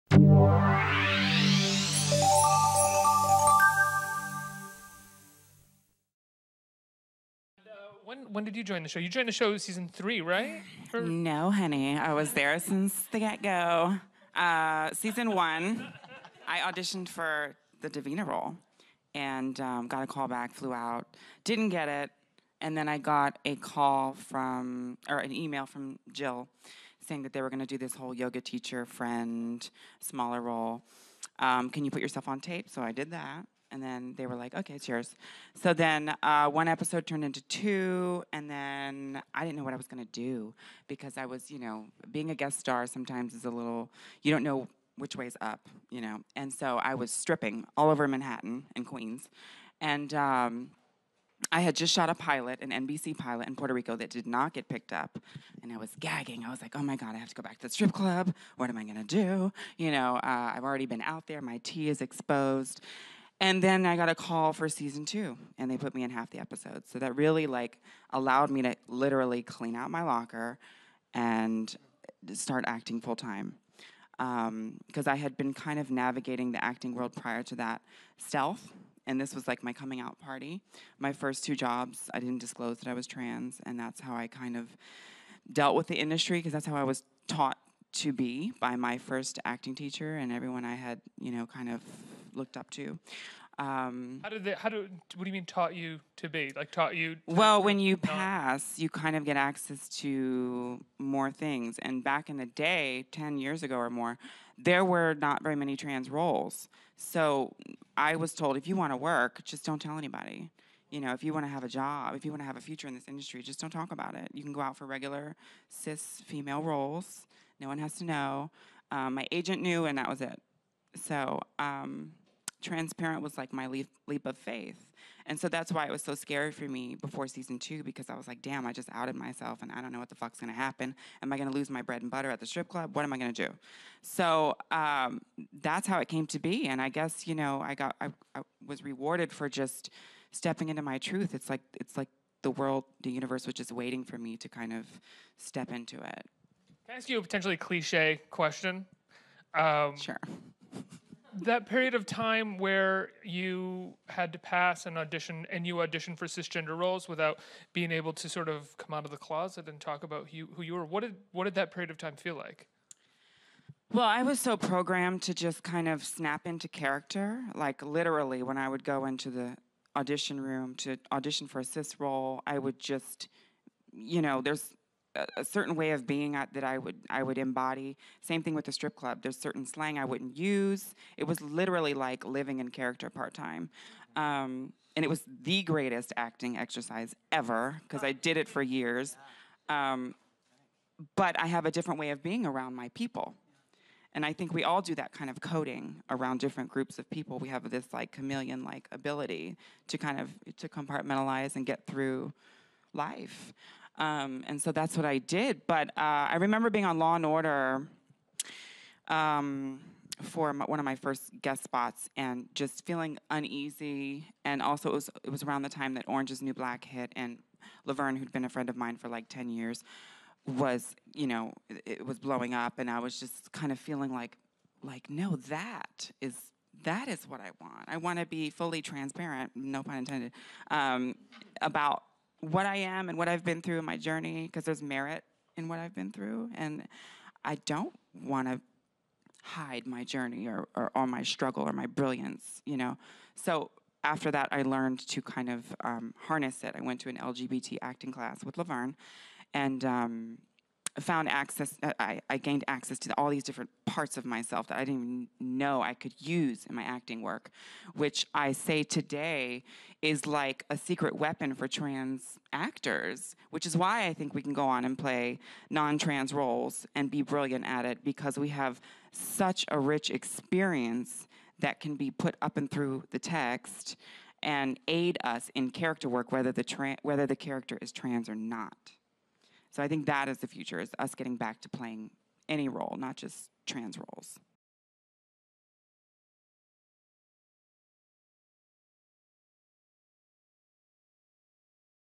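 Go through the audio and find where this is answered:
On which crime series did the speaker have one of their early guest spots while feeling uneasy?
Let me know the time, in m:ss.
3:26.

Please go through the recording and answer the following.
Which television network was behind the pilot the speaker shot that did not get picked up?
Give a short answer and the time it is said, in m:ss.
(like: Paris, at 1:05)
NBC, at 0:52.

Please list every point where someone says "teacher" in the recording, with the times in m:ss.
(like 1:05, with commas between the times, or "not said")
0:28, 1:29.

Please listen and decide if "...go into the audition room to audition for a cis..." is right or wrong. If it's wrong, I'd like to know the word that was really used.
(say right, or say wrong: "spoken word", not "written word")
right.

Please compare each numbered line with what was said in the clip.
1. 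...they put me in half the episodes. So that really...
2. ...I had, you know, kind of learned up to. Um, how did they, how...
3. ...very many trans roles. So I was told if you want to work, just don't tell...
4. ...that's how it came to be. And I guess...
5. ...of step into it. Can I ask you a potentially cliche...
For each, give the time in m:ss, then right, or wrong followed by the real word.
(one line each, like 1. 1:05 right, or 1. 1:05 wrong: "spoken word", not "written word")
1. 1:05 right
2. 1:30 wrong: "looked", not "learned"
3. 1:45 right
4. 2:15 right
5. 2:24 right.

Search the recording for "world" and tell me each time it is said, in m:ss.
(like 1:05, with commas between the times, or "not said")
1:16, 2:22.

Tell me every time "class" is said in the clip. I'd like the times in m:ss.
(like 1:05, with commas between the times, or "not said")
4:08.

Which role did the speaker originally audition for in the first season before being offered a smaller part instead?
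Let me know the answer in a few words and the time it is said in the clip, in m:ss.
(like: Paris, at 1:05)
Davina, at 0:17.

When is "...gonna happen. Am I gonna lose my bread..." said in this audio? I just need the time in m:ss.
2:10.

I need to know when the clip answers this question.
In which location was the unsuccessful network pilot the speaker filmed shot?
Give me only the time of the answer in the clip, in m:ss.
0:53.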